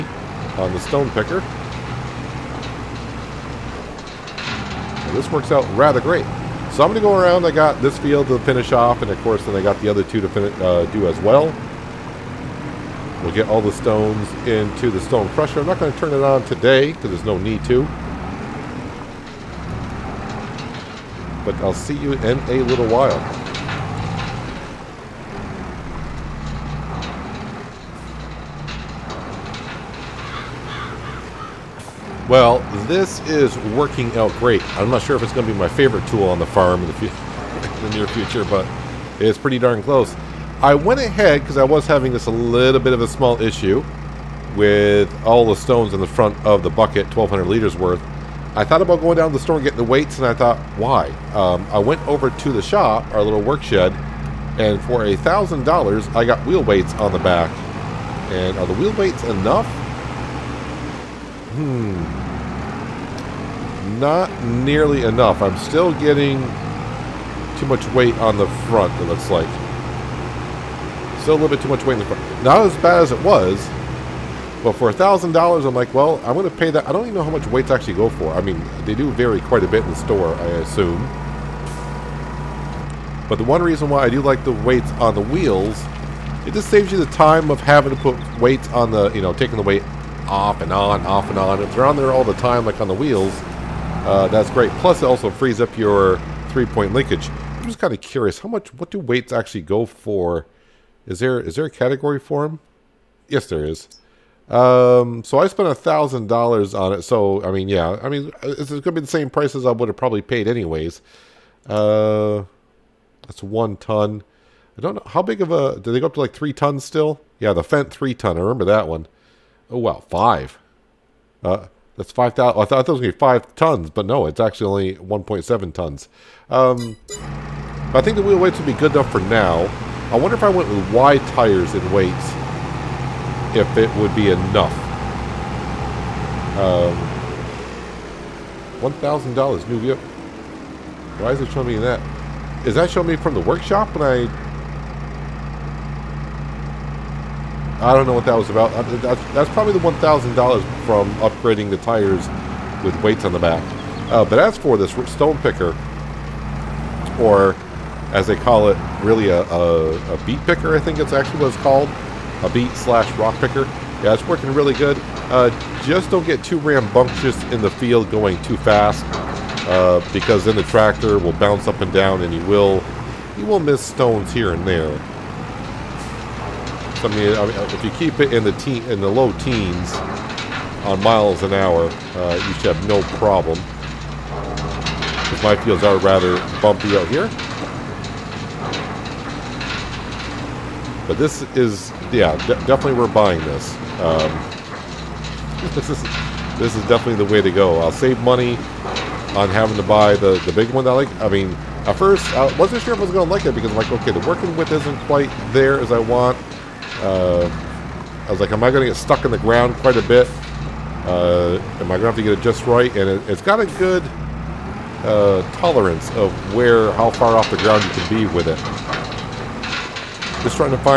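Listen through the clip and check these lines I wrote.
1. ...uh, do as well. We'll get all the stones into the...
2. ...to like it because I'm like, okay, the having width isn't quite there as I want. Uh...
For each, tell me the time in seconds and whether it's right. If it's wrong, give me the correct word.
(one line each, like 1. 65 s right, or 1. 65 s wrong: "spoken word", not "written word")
1. 10 s right
2. 203 s wrong: "working", not "having".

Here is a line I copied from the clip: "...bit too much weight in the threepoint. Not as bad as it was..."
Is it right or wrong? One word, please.
wrong.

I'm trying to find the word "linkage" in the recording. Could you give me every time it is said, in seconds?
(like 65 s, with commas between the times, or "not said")
96 s.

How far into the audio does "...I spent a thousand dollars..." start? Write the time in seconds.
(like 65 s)
105 s.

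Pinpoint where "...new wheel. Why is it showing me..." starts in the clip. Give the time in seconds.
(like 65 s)
139 s.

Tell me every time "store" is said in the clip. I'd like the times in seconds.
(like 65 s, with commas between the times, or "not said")
49 s, 79 s.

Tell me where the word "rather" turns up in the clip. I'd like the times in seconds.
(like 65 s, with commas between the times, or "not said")
5 s, 185 s.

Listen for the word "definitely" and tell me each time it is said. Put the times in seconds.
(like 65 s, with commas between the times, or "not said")
192 s, 196 s.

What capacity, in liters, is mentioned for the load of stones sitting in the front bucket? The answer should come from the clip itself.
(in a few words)
1,200 liters.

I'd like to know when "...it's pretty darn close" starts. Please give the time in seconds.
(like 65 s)
39 s.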